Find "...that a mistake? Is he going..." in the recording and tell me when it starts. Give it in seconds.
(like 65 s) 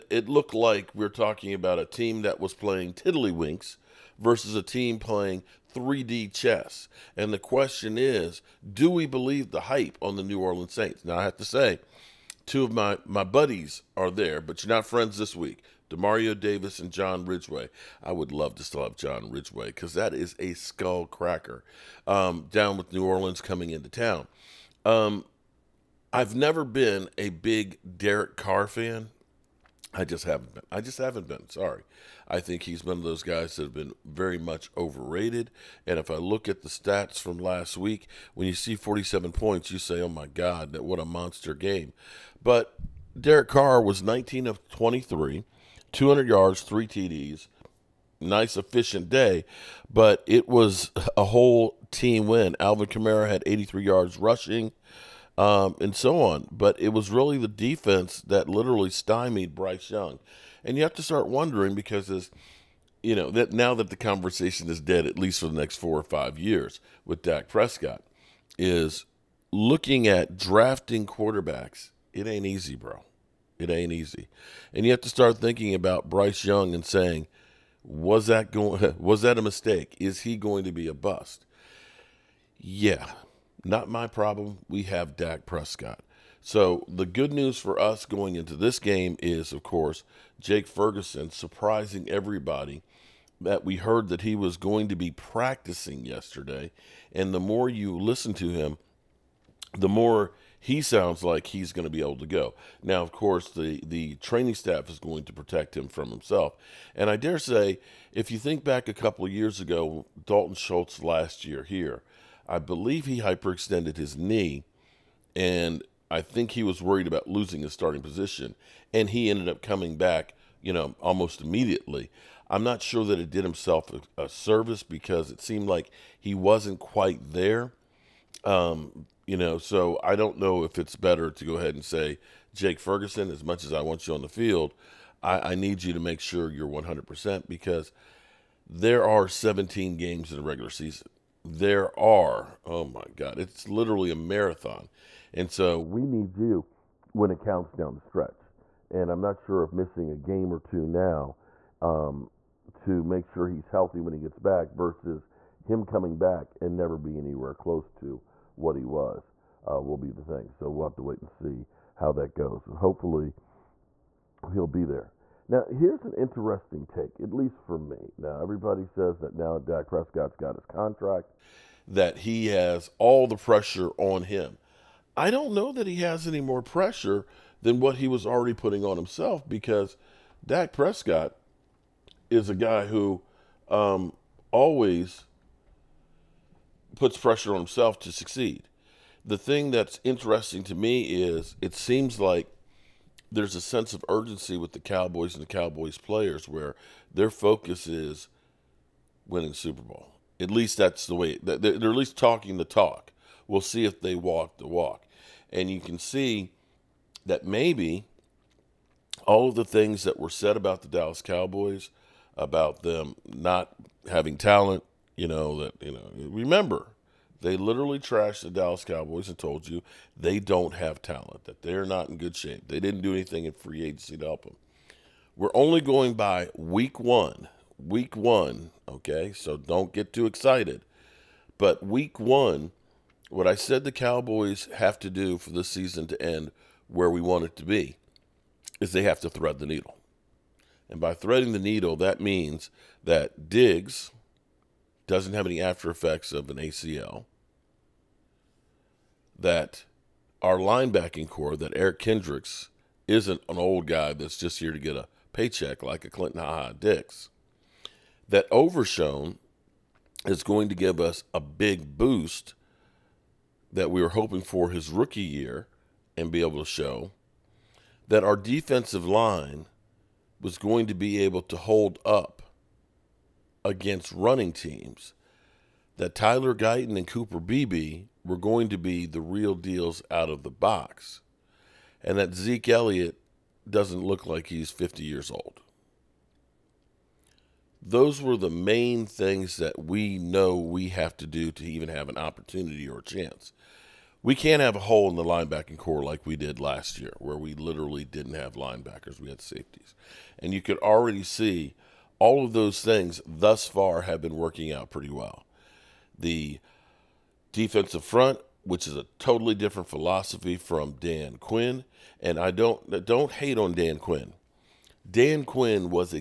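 79 s.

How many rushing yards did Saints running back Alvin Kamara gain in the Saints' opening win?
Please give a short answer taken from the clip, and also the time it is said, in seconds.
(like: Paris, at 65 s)
83, at 53 s.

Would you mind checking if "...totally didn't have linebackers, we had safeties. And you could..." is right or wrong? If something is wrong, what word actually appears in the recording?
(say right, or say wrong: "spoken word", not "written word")
wrong: "literally", not "totally".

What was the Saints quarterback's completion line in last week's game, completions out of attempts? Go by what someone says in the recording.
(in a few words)
19 of 23.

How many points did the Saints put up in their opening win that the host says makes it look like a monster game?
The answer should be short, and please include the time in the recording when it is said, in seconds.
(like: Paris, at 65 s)
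47, at 38 s.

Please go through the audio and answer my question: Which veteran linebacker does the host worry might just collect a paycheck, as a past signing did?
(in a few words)
Eric Kendricks.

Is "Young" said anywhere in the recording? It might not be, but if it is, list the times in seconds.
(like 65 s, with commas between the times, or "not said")
59 s, 76 s.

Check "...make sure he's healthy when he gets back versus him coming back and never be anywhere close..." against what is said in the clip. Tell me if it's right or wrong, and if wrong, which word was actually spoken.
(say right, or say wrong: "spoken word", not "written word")
right.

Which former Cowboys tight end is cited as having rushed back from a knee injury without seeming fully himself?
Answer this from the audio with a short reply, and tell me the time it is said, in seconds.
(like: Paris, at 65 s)
Dalton Schultz, at 110 s.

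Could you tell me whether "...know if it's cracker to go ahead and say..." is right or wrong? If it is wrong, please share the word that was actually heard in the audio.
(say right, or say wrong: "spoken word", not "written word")
wrong: "better", not "cracker".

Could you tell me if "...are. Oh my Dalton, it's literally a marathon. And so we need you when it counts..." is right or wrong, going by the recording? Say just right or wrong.
wrong.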